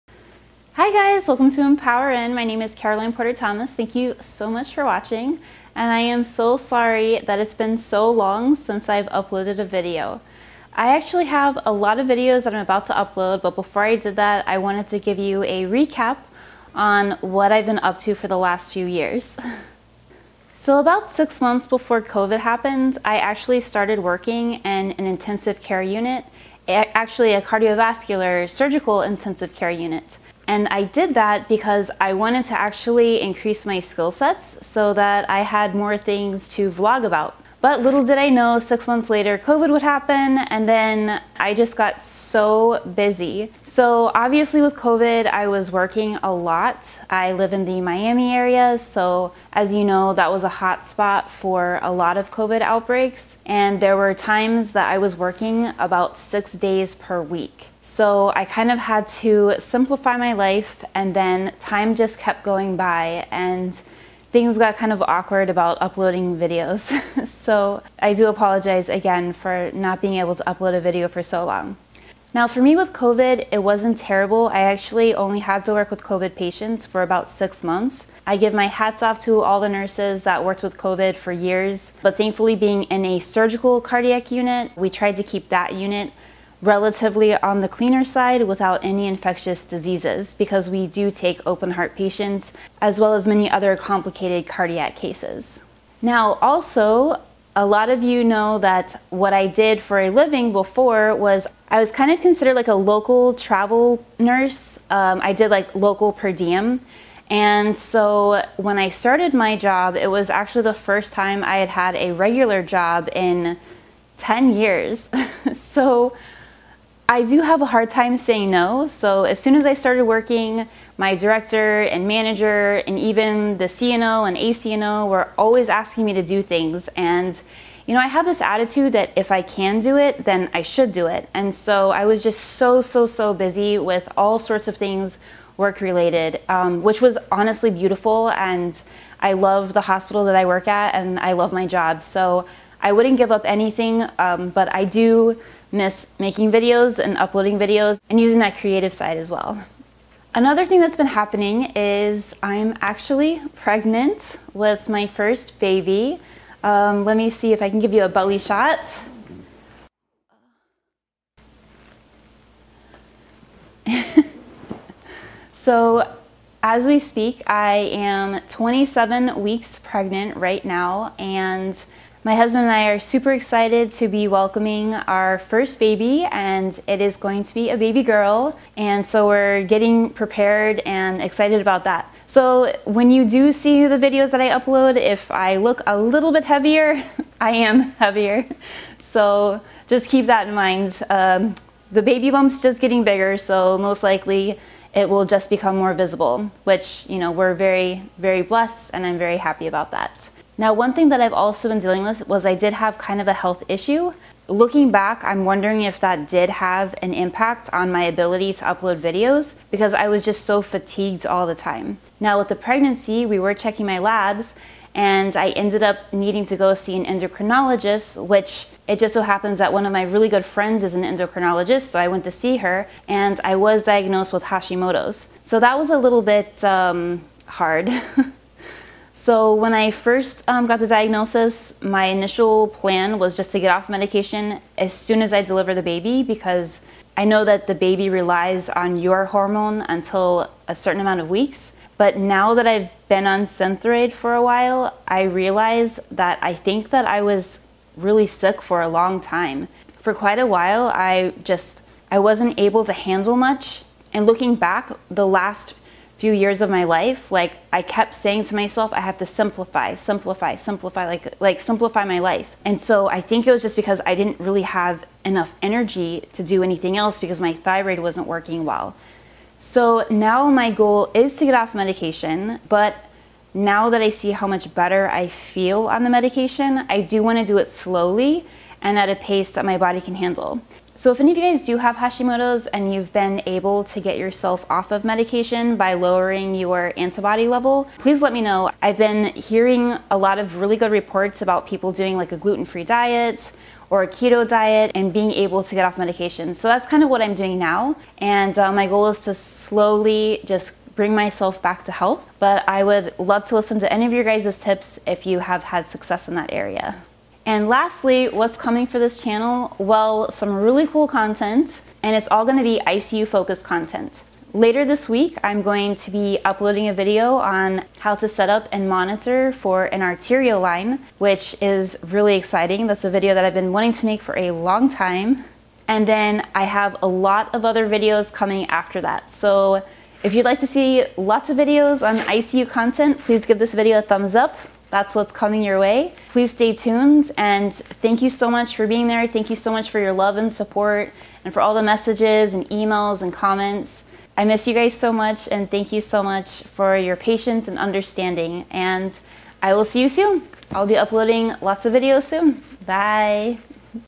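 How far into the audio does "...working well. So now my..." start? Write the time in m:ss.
4:28.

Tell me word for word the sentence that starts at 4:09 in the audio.
For quite a while, I just I wasn't able to handle much.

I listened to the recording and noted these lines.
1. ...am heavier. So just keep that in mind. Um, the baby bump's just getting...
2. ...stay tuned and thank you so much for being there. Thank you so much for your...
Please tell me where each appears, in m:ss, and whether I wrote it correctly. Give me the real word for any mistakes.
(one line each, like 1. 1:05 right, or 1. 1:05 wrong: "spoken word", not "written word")
1. 3:07 right
2. 5:36 right.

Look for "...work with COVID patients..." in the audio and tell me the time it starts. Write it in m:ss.
1:15.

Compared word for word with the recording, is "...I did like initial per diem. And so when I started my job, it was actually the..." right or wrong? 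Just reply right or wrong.
wrong.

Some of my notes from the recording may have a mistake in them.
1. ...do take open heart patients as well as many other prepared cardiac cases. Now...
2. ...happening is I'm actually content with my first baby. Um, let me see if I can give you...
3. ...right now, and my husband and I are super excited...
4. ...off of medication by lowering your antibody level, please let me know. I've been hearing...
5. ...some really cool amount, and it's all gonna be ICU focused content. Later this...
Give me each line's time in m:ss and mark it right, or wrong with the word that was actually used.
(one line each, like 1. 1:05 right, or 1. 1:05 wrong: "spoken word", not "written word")
1. 1:30 wrong: "complicated", not "prepared"
2. 2:31 wrong: "pregnant", not "content"
3. 2:50 right
4. 4:44 right
5. 5:10 wrong: "content", not "amount".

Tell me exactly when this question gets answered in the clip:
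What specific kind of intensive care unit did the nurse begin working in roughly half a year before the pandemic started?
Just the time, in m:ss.
0:27.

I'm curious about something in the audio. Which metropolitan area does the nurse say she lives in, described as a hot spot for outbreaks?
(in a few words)
Miami.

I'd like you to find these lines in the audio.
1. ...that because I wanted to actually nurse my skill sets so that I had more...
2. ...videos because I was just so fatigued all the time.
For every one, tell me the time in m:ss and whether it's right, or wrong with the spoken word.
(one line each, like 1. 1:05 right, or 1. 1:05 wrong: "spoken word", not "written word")
1. 0:31 wrong: "increase", not "nurse"
2. 3:28 right.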